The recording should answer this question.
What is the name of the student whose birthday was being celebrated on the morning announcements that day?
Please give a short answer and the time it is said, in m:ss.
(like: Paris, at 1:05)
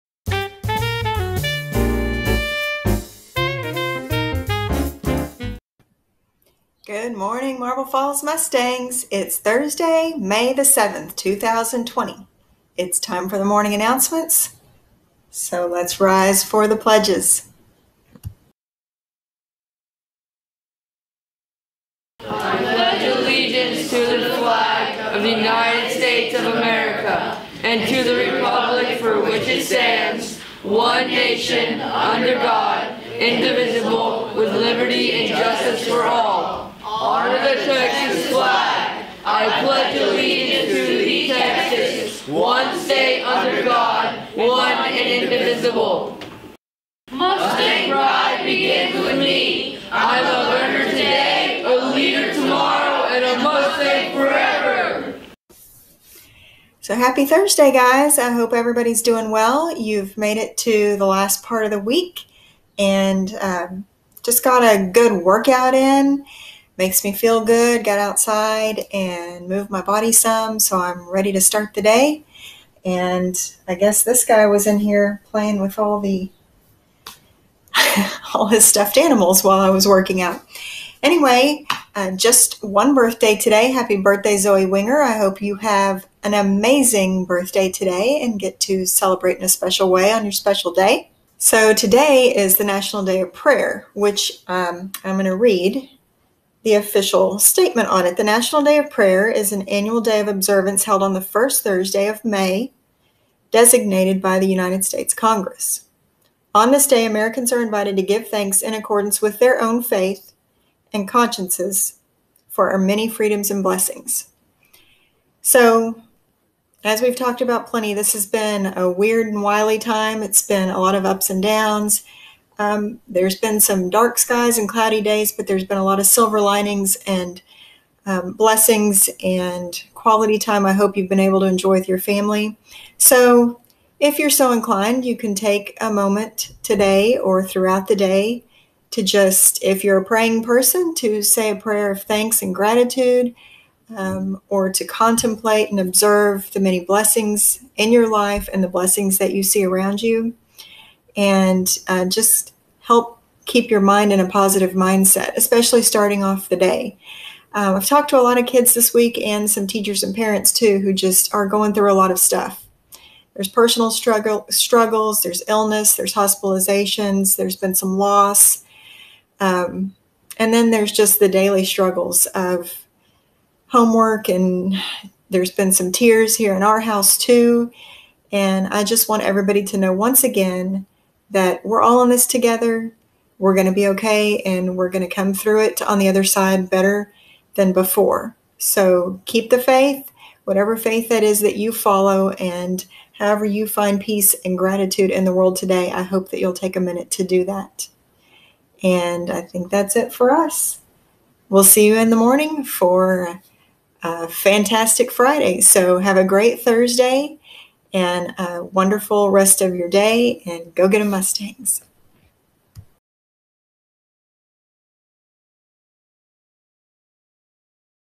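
Zoe Winger, at 1:24.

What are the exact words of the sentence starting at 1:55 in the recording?
So, as we've talked about plenty, this has been a weird and wily time.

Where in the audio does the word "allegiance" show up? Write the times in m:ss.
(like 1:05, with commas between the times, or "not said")
0:23, 0:39.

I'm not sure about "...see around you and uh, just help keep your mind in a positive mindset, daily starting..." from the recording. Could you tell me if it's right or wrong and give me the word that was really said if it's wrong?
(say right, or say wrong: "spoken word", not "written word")
wrong: "especially", not "daily".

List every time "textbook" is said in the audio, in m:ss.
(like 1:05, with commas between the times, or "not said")
not said.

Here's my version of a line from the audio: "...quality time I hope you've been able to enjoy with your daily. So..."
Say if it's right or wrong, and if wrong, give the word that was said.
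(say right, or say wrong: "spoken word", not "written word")
wrong: "family", not "daily".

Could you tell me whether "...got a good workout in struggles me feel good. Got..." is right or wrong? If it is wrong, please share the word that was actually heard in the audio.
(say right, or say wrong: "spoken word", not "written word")
wrong: "makes", not "struggles".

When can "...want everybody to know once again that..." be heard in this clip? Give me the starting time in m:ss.
2:59.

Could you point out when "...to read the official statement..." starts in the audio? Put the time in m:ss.
1:35.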